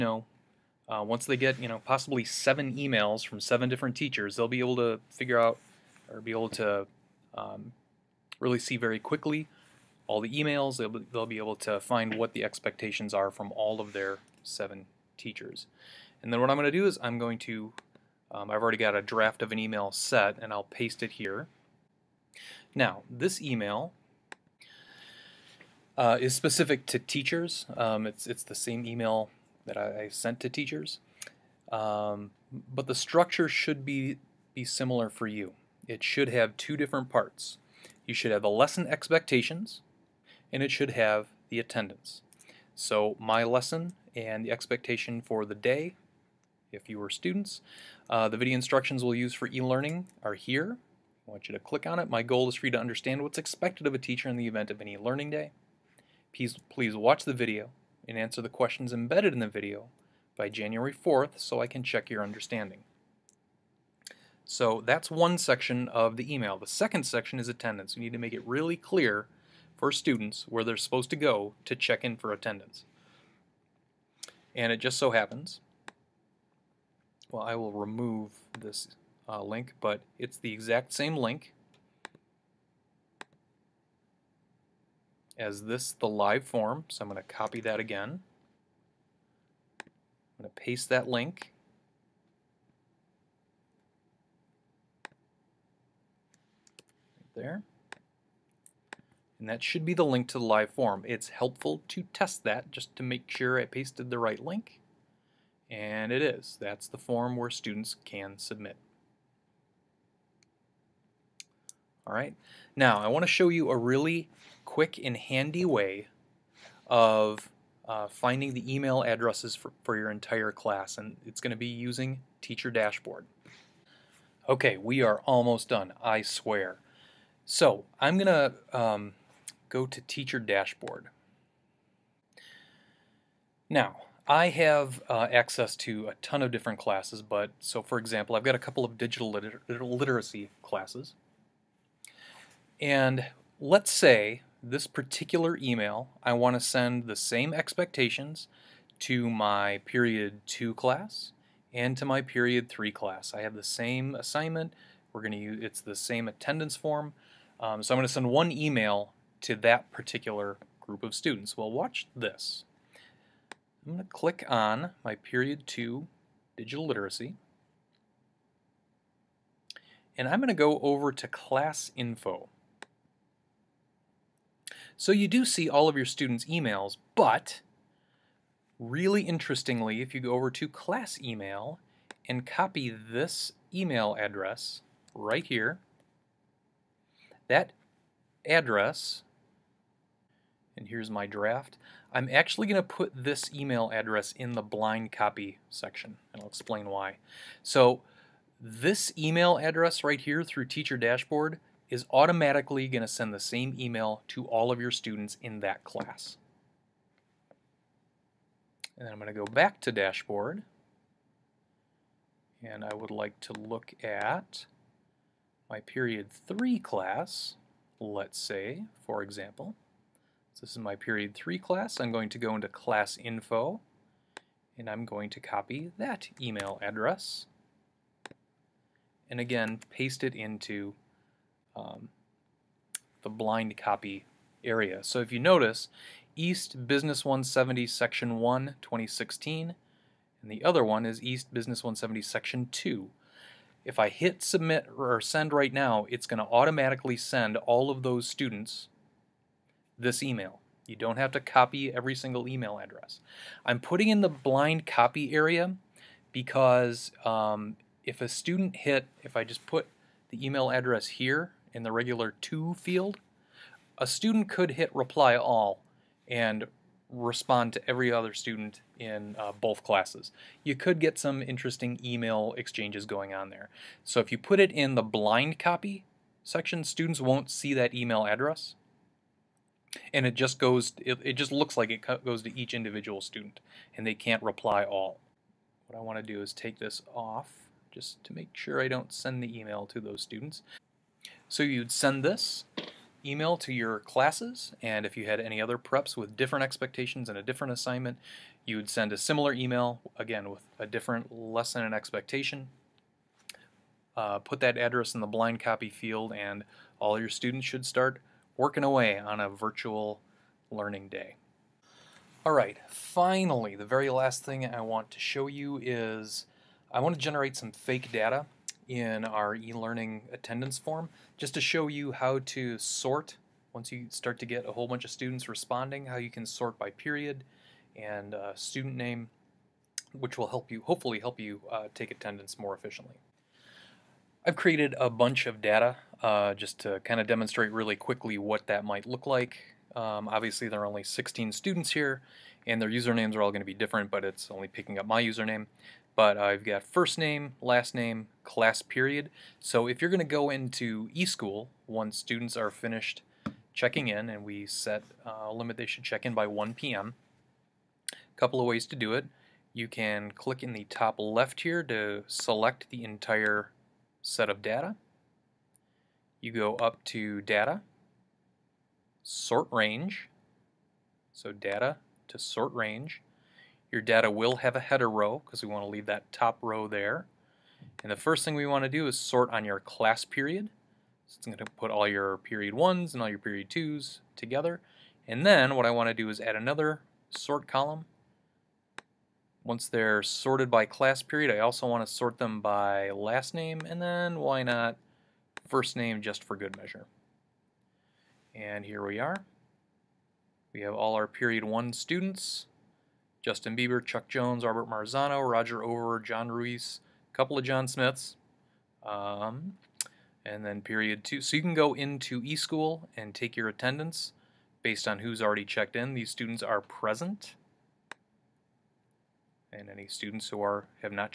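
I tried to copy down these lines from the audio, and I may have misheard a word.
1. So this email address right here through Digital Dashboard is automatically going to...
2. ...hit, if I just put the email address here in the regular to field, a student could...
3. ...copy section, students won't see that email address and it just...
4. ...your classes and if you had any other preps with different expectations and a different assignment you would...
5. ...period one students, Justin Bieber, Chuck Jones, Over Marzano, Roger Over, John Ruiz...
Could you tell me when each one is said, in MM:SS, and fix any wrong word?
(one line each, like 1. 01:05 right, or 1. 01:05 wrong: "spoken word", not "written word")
1. 03:17 wrong: "Teacher", not "Digital"
2. 04:18 right
3. 04:35 right
4. 04:53 right
5. 06:41 wrong: "Robert", not "Over".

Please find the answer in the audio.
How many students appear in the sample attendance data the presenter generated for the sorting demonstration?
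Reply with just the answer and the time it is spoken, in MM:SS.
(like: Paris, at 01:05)
16, at 05:41.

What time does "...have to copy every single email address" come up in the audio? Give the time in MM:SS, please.
04:11.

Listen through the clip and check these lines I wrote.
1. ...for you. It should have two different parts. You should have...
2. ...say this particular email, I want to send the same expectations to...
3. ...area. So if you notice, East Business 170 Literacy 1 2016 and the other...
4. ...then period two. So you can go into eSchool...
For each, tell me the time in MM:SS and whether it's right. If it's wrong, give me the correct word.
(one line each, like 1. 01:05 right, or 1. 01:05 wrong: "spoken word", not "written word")
1. 00:35 right
2. 02:23 right
3. 03:54 wrong: "Section", not "Literacy"
4. 06:50 right.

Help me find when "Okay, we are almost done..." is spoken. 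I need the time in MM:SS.
02:04.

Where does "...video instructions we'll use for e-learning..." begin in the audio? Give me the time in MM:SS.
00:48.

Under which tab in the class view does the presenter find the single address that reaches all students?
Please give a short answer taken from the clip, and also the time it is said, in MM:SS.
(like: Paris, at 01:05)
Class Email, at 03:00.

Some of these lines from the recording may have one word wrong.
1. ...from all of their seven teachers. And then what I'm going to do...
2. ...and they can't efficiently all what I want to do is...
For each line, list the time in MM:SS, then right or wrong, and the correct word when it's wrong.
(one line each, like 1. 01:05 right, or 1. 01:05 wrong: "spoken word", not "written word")
1. 00:13 right
2. 04:43 wrong: "reply", not "efficiently".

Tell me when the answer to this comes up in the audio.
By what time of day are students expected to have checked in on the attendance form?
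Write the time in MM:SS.
05:56.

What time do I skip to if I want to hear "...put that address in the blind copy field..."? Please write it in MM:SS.
05:04.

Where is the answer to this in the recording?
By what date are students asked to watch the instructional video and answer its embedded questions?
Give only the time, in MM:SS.
01:00.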